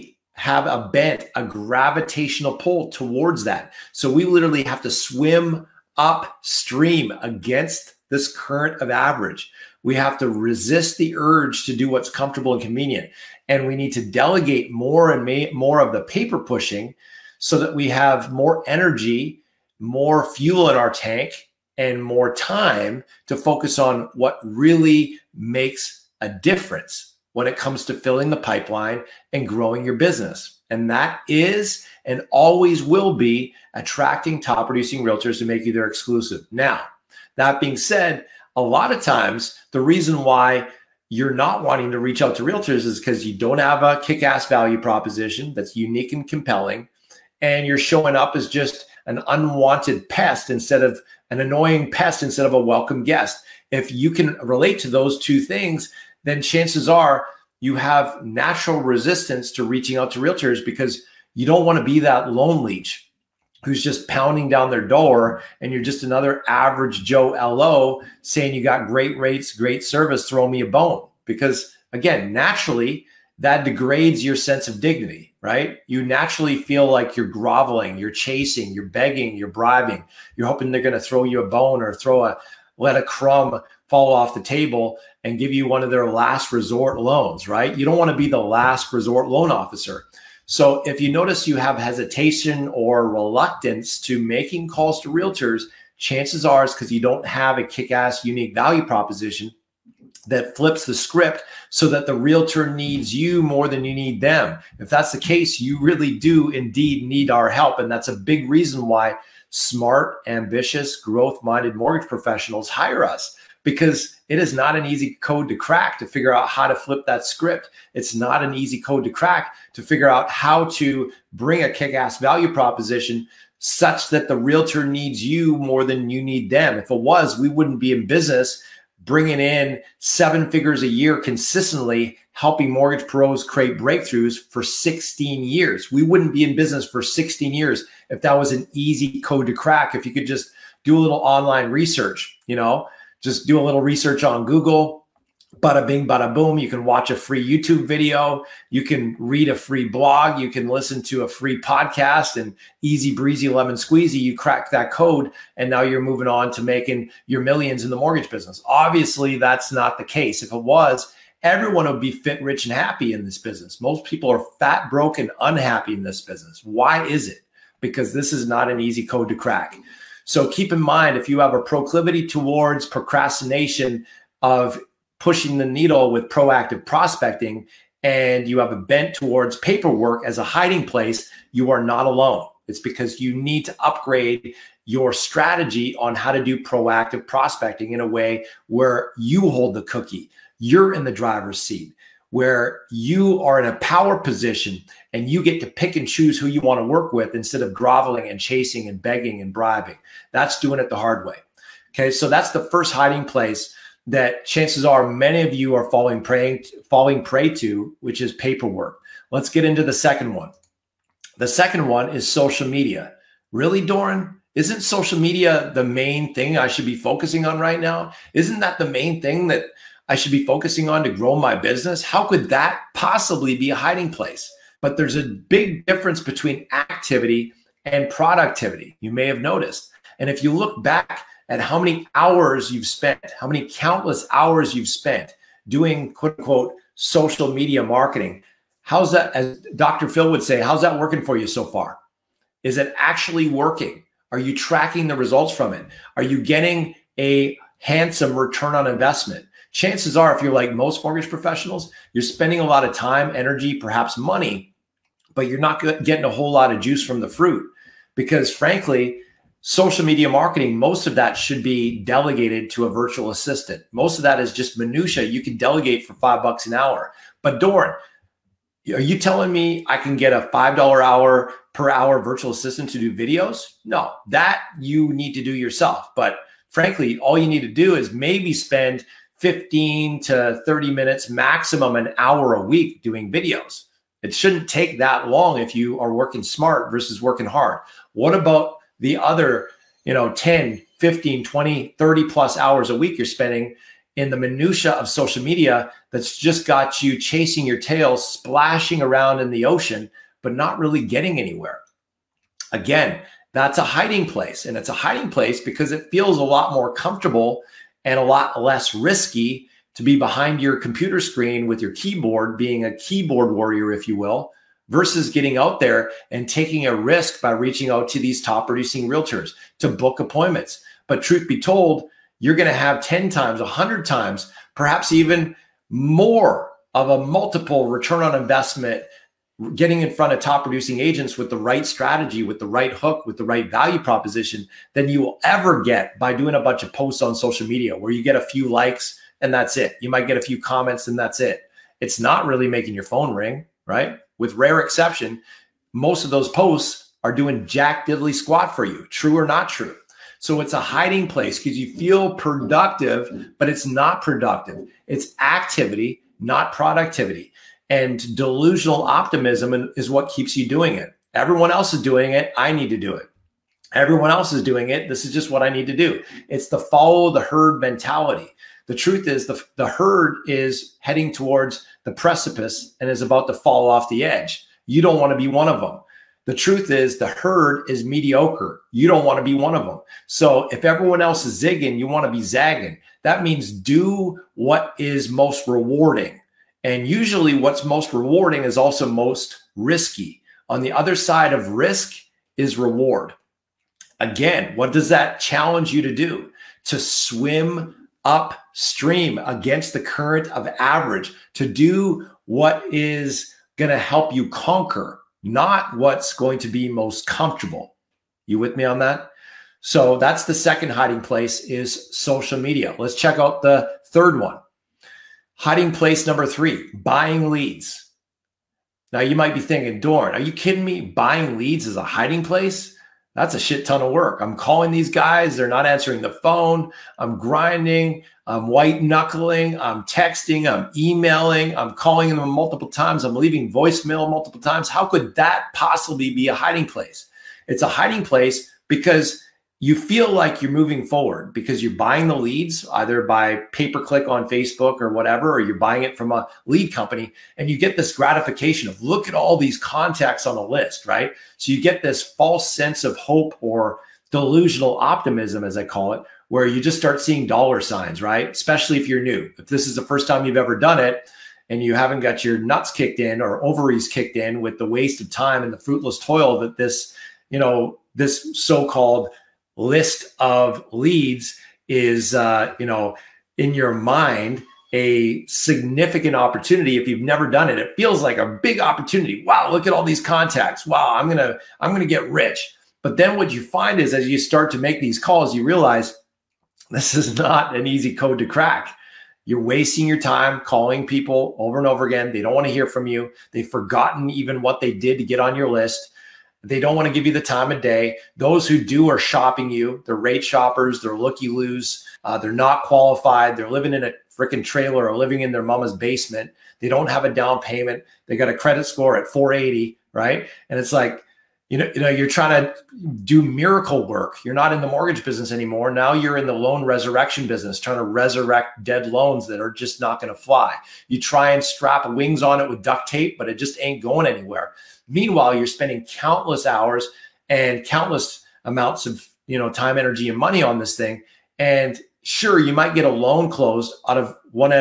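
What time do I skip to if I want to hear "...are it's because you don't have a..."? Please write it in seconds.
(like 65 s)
96 s.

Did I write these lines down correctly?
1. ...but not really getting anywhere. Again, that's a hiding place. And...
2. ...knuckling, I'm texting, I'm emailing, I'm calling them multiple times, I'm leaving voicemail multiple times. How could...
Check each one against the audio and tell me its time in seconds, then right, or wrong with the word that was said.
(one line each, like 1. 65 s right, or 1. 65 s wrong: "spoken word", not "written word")
1. 300 s right
2. 429 s right.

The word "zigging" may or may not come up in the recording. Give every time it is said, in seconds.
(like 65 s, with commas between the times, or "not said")
381 s.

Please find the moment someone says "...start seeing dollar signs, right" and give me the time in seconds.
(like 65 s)
456 s.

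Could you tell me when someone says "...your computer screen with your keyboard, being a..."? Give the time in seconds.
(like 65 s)
310 s.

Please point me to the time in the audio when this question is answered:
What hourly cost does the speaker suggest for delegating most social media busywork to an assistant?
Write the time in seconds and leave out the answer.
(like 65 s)
266 s.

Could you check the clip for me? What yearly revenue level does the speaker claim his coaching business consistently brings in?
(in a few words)
Seven figures.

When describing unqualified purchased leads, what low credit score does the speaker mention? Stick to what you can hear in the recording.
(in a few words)
480.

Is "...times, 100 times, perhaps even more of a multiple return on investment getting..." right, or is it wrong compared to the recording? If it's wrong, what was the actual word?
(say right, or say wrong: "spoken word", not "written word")
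right.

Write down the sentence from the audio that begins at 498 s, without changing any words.
Those who do are shopping you.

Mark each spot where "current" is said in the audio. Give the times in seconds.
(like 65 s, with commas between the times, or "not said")
8 s, 400 s.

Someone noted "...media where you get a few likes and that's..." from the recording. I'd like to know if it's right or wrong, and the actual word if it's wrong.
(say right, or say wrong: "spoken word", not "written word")
right.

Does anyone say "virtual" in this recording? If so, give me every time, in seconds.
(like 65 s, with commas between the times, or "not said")
262 s, 272 s.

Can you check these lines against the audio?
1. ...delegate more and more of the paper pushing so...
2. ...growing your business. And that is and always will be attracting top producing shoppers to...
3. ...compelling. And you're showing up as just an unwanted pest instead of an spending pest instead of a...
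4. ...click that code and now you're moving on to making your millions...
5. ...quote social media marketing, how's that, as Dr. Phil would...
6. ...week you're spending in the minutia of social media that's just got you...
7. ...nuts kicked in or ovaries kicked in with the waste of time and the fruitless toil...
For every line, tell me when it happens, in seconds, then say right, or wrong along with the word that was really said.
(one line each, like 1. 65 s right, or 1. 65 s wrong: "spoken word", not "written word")
1. 14 s right
2. 29 s wrong: "realtors", not "shoppers"
3. 46 s wrong: "annoying", not "spending"
4. 154 s wrong: "crack", not "click"
5. 236 s wrong: "unquote", not "quote"
6. 292 s right
7. 462 s right.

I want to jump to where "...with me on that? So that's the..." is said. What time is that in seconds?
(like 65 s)
408 s.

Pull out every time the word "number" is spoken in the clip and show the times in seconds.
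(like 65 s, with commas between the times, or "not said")
416 s.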